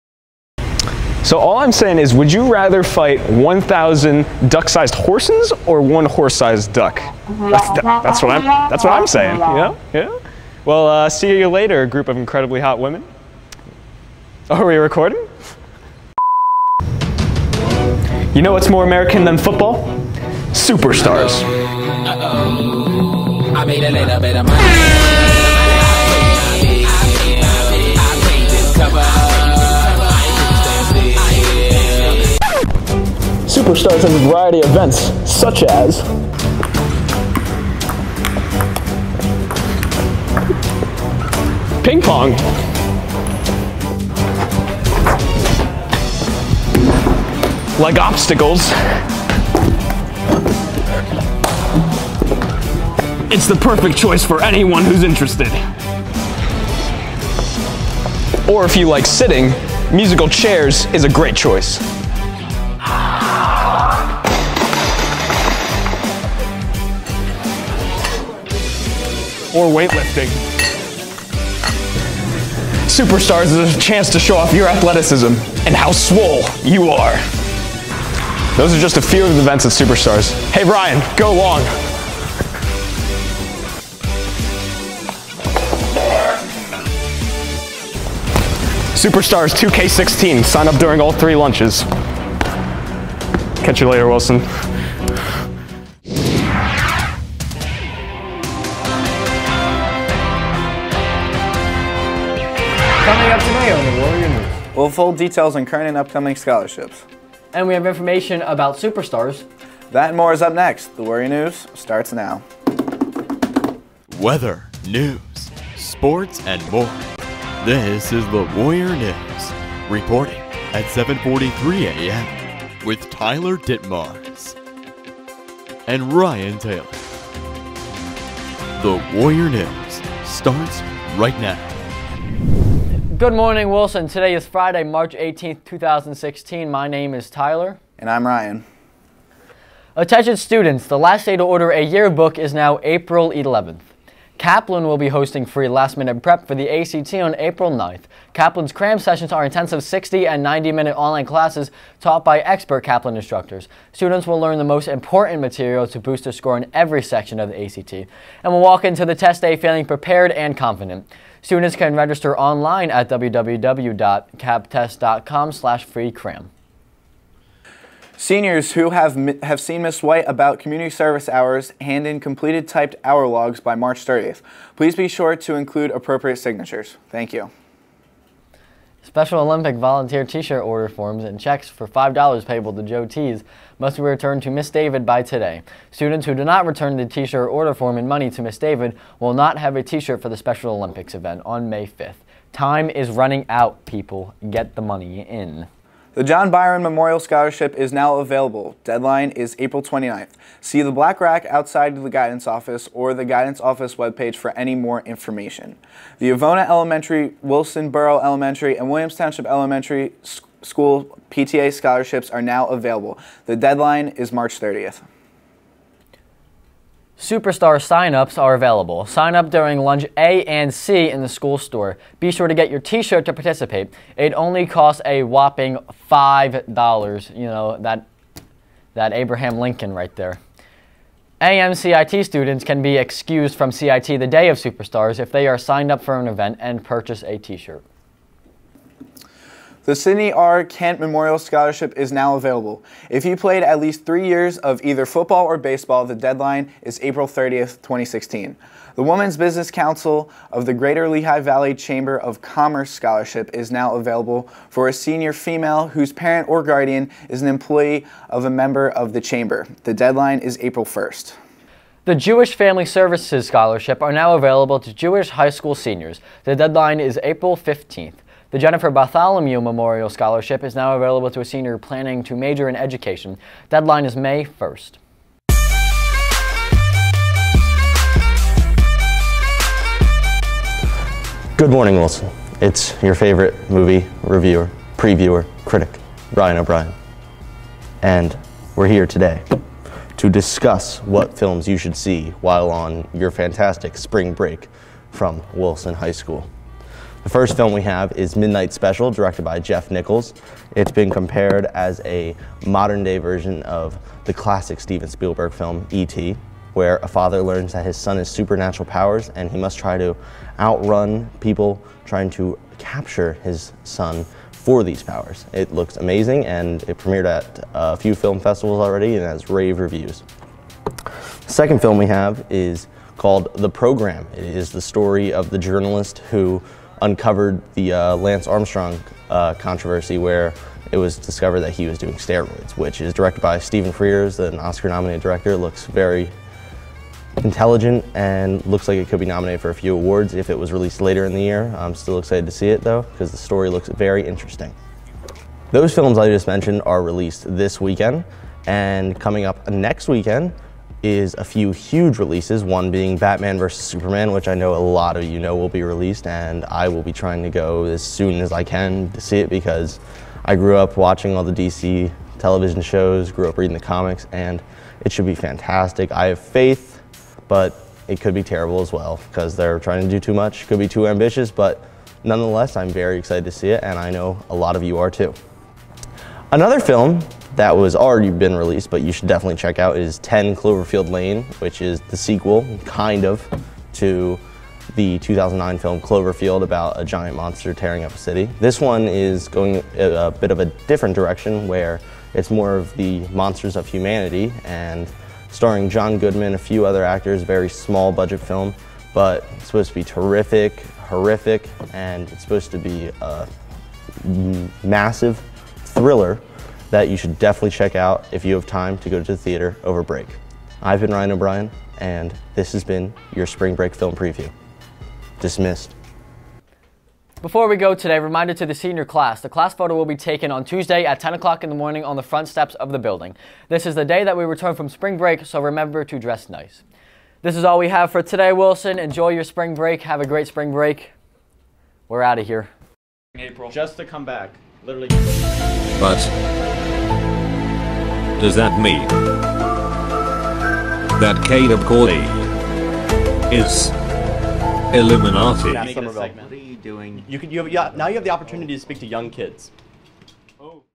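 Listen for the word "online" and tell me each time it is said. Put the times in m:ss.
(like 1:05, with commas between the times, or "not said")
2:30, 2:42.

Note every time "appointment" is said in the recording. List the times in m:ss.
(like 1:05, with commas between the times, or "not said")
not said.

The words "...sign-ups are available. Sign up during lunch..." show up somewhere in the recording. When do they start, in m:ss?
3:37.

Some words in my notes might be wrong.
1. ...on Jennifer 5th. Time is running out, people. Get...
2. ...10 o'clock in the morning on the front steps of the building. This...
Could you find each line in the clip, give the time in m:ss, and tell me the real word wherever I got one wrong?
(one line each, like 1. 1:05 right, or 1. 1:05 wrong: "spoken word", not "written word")
1. 3:11 wrong: "May", not "Jennifer"
2. 7:01 right.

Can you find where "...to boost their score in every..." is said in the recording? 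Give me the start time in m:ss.
2:35.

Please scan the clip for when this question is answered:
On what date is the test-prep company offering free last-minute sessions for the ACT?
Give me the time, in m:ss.
2:27.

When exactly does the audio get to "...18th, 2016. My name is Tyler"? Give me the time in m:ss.
2:15.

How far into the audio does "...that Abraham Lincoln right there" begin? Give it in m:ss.
3:48.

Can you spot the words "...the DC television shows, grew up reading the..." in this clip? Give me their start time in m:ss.
6:01.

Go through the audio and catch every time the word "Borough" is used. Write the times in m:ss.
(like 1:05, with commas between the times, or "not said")
3:27.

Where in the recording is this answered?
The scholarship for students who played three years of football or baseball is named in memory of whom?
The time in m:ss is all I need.
3:59.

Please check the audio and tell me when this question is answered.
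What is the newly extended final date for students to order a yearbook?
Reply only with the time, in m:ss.
2:22.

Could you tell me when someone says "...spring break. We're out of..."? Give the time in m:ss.
7:10.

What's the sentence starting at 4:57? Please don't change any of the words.
The first film we have is Midnight Special, directed by Jeff Nichols.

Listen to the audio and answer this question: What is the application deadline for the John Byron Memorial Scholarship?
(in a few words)
April 29th.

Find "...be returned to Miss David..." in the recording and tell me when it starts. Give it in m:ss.
3:03.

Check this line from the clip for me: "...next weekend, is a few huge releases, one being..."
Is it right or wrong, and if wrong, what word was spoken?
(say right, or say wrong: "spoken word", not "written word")
right.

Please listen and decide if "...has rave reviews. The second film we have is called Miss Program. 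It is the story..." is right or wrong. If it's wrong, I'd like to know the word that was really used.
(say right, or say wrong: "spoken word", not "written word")
wrong: "The", not "Miss".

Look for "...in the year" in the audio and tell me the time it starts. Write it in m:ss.
5:41.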